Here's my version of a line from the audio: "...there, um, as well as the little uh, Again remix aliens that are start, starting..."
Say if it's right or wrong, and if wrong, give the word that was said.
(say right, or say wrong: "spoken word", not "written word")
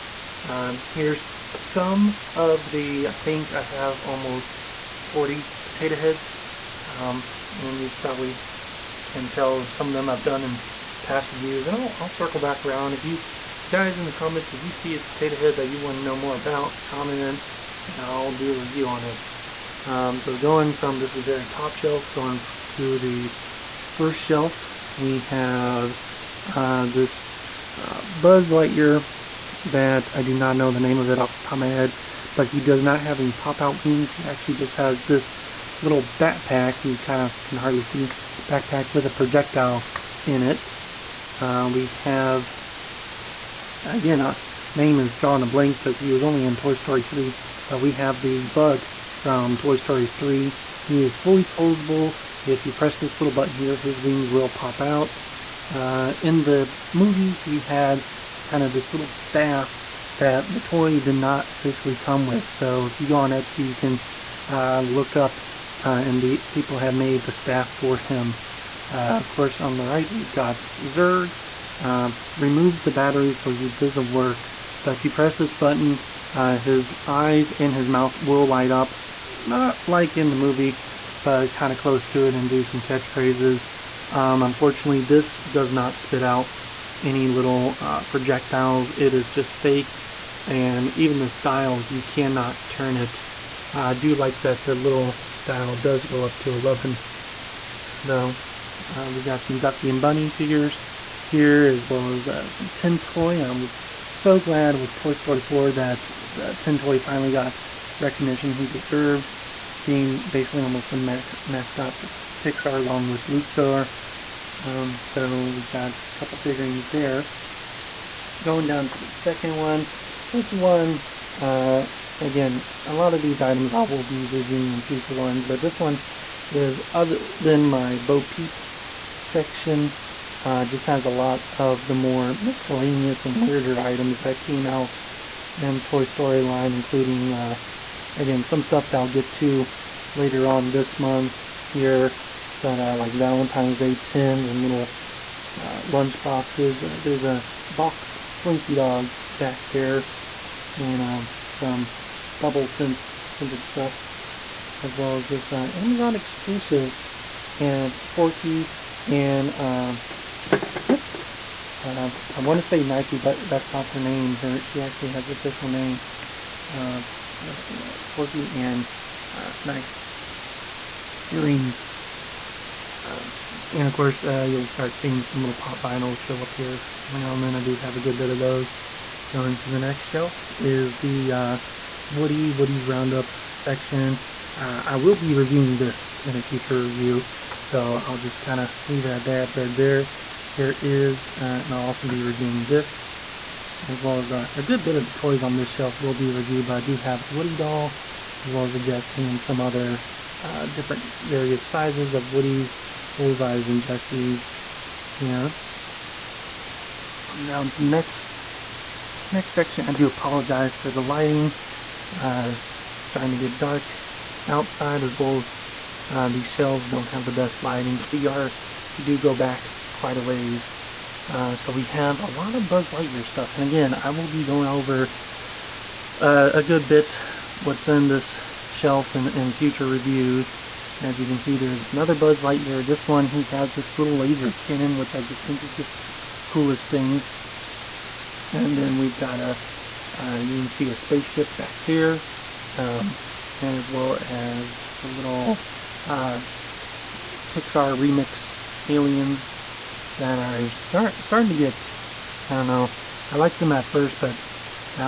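wrong: "Pixar", not "Again".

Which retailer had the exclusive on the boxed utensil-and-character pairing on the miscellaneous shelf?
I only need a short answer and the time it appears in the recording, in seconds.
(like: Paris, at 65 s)
Amazon, at 155 s.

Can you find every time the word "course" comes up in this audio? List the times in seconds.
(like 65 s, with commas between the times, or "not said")
69 s, 173 s.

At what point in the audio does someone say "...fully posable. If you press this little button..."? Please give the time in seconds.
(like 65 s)
51 s.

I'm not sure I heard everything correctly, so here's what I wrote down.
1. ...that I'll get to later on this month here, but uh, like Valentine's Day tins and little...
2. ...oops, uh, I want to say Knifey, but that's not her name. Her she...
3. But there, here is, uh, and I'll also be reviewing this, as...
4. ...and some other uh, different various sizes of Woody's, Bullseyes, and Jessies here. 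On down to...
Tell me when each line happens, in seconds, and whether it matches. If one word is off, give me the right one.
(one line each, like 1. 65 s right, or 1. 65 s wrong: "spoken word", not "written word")
1. 138 s right
2. 160 s right
3. 189 s right
4. 199 s right.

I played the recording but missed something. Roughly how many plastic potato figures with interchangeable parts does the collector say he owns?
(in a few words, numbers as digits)
40.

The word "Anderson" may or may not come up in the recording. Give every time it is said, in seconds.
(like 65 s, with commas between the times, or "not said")
not said.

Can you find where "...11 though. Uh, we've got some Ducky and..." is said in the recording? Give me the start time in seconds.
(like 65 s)
96 s.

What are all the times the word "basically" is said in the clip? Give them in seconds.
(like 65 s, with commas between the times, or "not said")
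110 s.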